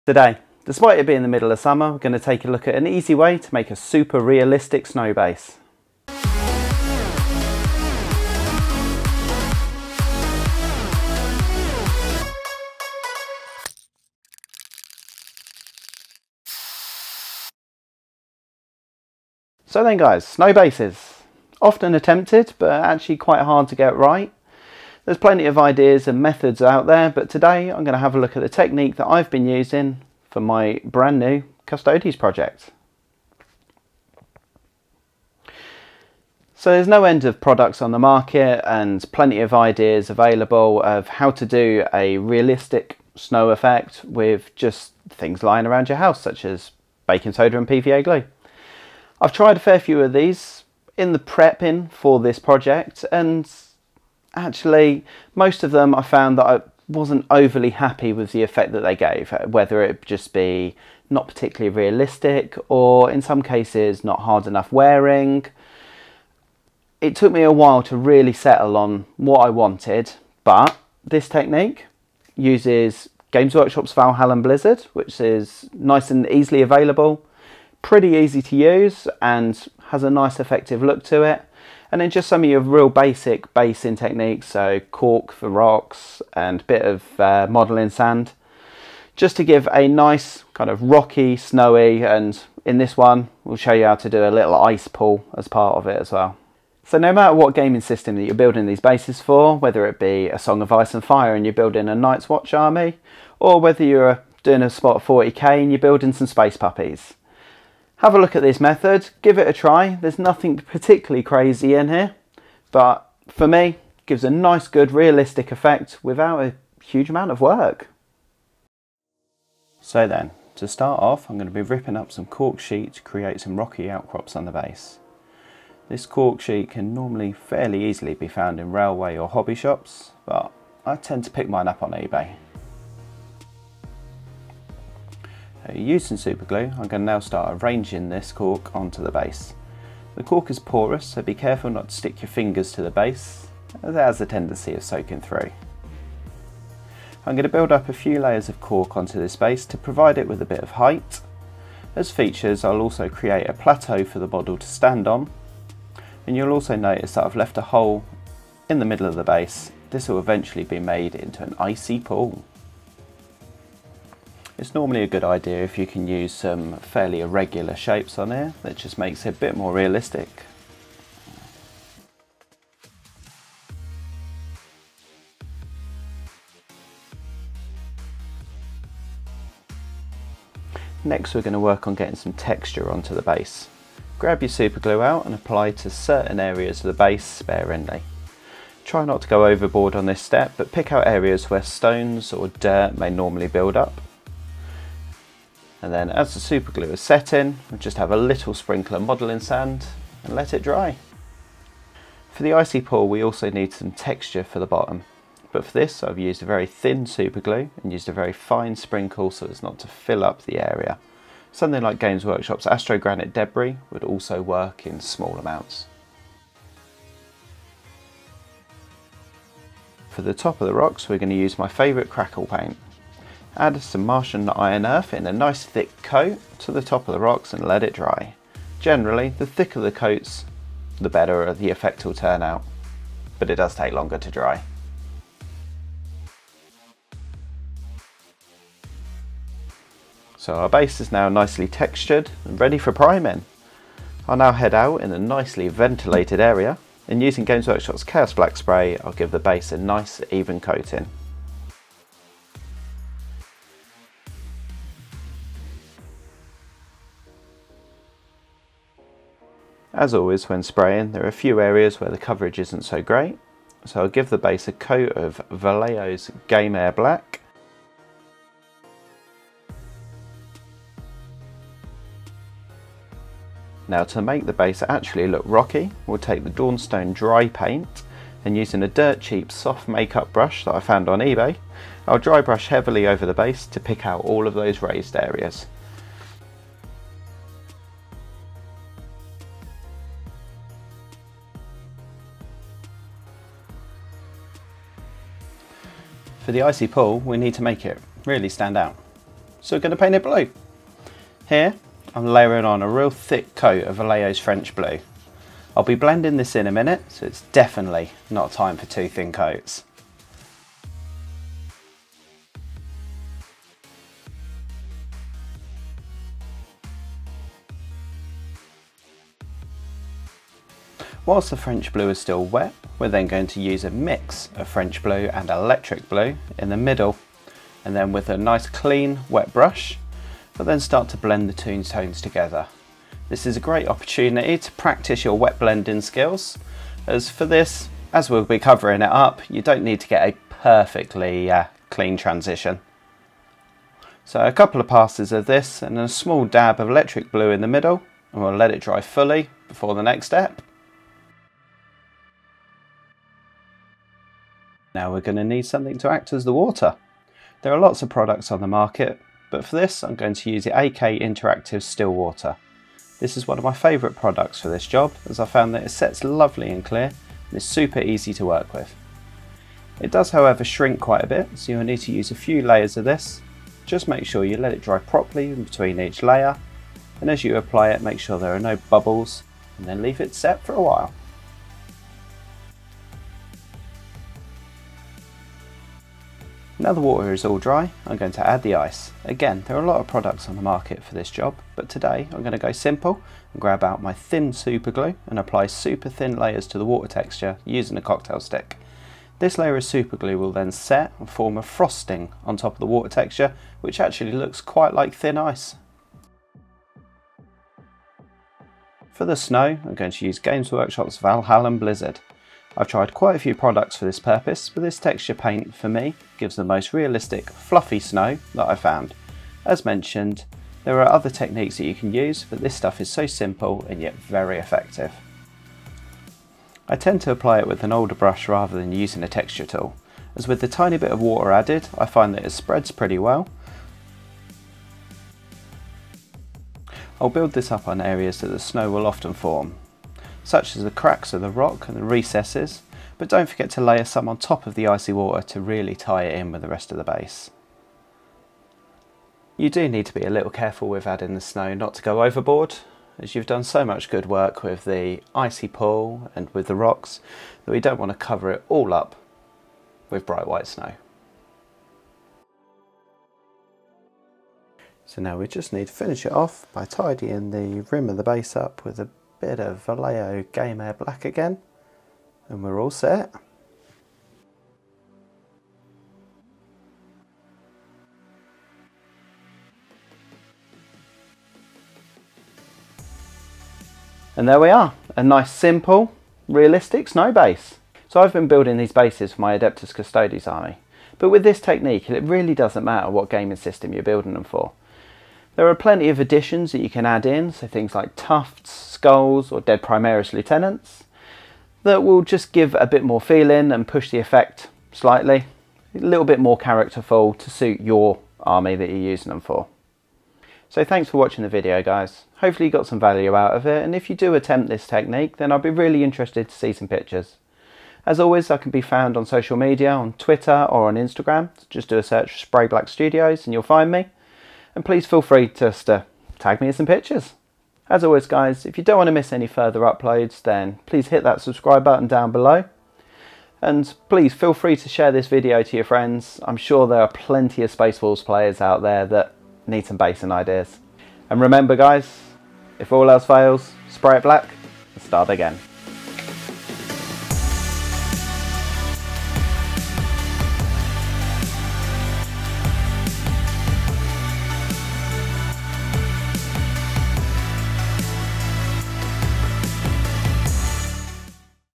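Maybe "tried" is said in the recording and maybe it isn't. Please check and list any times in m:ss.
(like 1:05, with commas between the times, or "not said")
0:49, 6:52.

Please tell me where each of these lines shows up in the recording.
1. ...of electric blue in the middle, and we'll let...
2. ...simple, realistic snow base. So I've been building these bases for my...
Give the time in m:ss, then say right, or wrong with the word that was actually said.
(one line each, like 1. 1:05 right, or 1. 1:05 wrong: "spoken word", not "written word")
1. 5:46 right
2. 8:05 right.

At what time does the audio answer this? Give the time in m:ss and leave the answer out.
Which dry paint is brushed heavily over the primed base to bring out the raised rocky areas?
4:36.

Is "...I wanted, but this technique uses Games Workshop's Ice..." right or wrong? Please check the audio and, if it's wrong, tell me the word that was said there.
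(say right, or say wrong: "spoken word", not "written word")
wrong: "Valhallan", not "Ice".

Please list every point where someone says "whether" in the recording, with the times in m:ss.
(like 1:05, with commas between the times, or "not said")
0:59, 1:39, 1:43.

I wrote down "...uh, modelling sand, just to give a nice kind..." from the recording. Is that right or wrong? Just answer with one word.
right.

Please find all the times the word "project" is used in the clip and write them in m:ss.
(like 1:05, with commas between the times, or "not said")
0:32, 0:52.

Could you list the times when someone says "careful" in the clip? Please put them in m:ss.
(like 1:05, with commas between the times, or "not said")
2:21, 7:30.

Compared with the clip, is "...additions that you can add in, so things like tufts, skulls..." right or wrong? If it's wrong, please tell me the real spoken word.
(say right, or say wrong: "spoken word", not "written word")
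right.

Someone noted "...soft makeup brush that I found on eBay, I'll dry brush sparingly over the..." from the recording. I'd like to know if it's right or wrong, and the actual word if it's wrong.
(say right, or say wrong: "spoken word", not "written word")
wrong: "heavily", not "sparingly".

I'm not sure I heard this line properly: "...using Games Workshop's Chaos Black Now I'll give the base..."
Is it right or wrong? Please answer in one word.
wrong.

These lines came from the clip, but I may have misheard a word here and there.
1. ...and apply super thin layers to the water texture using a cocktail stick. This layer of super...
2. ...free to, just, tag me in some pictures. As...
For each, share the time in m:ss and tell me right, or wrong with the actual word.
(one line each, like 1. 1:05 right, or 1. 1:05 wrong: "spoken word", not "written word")
1. 6:35 right
2. 8:45 right.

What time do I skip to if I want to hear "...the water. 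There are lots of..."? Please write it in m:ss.
5:56.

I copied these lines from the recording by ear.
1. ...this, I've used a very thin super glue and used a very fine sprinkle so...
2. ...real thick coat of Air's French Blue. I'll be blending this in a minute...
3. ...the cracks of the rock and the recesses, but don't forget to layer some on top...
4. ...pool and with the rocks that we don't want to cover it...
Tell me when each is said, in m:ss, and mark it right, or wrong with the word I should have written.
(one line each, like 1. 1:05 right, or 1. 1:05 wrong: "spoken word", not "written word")
1. 3:25 right
2. 5:02 wrong: "Vallejo", not "Air"
3. 7:20 right
4. 7:35 right.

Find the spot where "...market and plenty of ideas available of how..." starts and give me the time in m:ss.
0:37.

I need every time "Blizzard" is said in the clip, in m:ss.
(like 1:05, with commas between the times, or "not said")
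1:14, 6:51.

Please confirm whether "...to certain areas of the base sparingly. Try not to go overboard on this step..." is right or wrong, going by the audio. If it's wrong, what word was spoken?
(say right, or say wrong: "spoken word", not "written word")
right.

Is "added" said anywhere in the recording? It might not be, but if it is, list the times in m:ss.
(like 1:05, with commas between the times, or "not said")
7:11.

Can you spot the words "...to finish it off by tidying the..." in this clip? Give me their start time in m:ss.
7:45.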